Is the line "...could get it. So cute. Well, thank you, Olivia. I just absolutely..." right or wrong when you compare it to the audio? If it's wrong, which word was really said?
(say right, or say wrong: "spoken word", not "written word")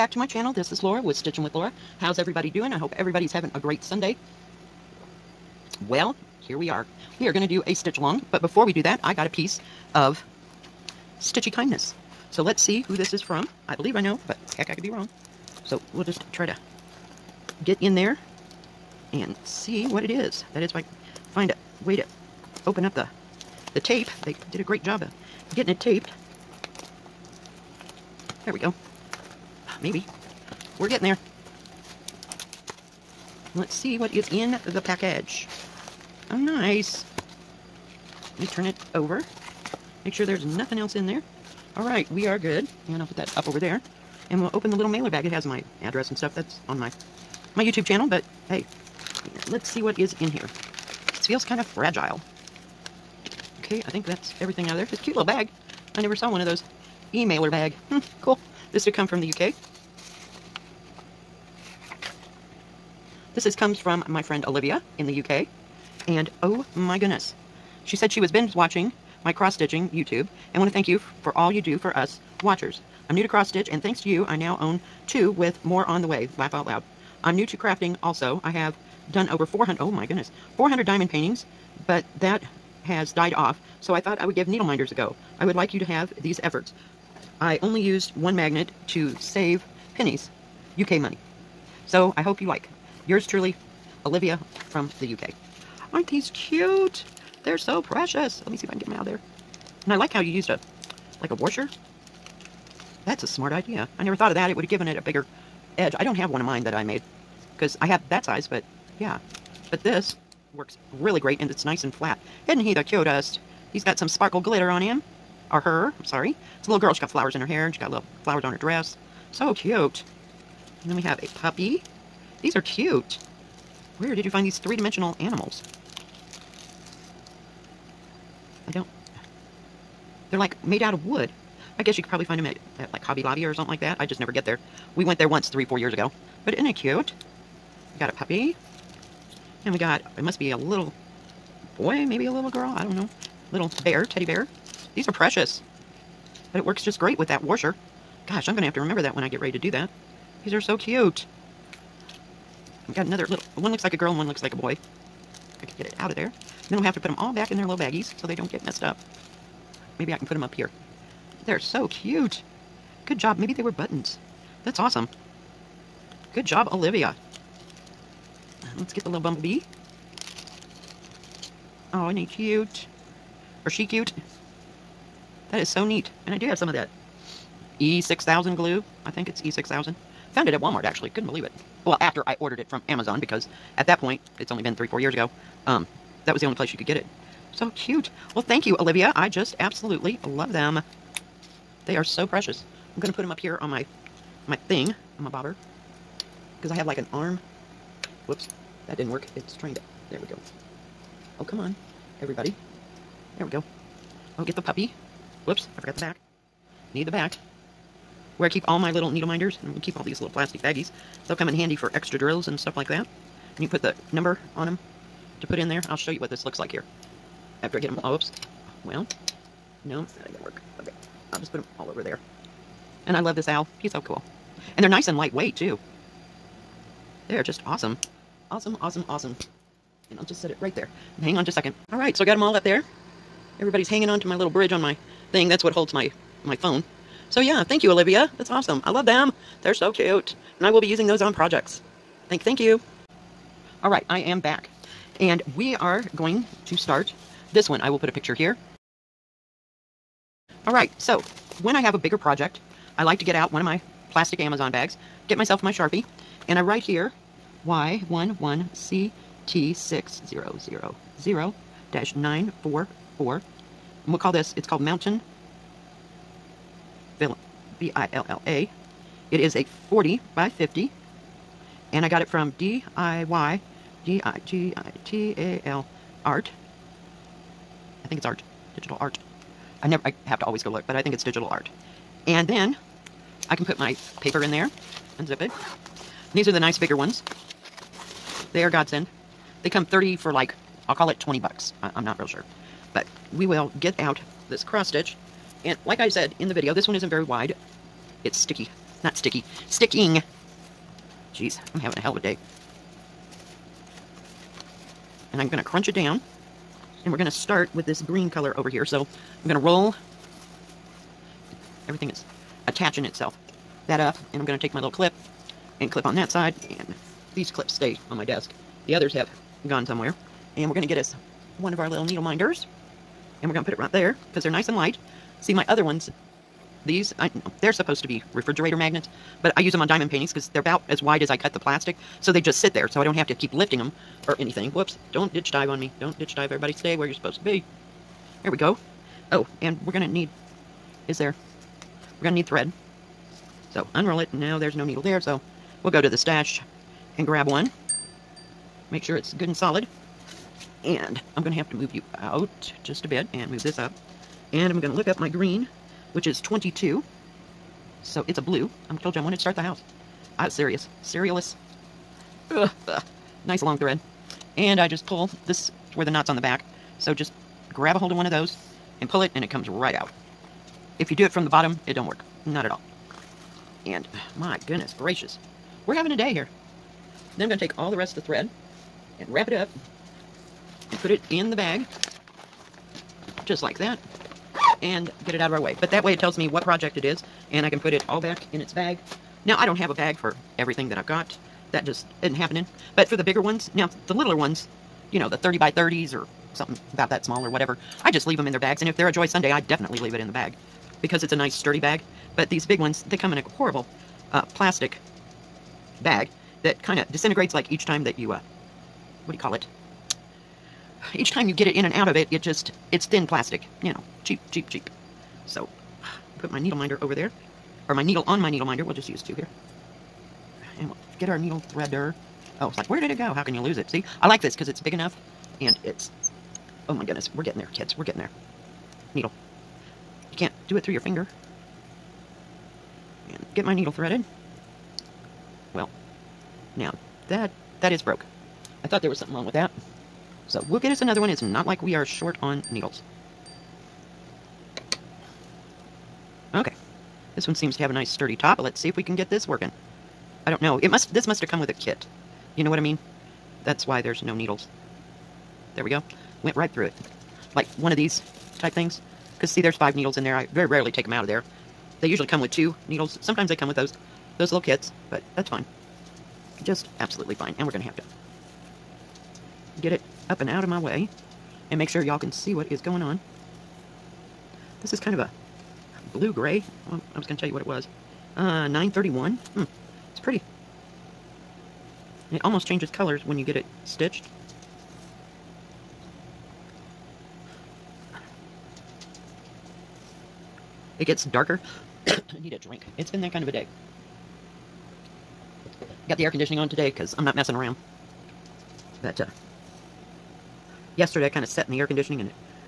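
right.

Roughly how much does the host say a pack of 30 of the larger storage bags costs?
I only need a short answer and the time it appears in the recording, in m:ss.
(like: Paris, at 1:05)
20 bucks, at 4:51.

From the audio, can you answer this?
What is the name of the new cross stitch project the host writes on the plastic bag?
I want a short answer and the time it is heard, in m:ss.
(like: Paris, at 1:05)
Mountain Villa, at 4:24.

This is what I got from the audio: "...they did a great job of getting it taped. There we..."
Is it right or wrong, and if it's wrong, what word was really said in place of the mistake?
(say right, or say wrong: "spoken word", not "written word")
right.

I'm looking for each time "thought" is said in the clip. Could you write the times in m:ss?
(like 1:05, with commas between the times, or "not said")
1:24, 1:44, 7:18.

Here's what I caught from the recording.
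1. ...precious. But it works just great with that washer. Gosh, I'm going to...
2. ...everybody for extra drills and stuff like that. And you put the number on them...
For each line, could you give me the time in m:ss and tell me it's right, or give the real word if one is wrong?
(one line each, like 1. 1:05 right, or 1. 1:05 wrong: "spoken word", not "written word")
1. 2:25 right
2. 3:31 wrong: "handy", not "everybody".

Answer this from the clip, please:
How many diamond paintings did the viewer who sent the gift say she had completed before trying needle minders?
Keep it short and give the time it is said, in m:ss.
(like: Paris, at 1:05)
400, at 1:20.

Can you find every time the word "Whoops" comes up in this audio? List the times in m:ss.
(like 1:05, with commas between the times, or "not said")
3:18, 3:25, 5:34.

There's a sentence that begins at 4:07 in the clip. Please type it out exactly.
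I will put a picture here.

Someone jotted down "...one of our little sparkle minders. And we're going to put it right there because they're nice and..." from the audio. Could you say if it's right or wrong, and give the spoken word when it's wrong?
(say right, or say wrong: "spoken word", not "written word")
wrong: "needle", not "sparkle".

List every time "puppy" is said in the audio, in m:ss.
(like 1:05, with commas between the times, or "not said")
2:01, 2:18, 3:24.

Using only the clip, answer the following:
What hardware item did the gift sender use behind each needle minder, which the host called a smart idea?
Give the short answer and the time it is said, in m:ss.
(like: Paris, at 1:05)
A washer, at 1:41.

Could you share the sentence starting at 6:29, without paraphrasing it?
Now I don't have a bag for everything that I've got.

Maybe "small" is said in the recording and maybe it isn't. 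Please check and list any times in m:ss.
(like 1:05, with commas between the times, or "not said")
6:37.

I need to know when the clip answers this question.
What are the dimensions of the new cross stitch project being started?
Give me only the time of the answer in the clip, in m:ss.
4:29.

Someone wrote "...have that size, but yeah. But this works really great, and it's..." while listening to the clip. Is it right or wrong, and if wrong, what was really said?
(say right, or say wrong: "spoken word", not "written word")
right.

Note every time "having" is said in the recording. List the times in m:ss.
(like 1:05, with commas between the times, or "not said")
0:03, 5:01, 6:15.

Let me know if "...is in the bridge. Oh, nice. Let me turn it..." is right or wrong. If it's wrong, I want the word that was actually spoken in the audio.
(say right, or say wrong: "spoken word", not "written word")
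wrong: "package", not "bridge".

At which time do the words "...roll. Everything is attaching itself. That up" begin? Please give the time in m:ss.
5:09.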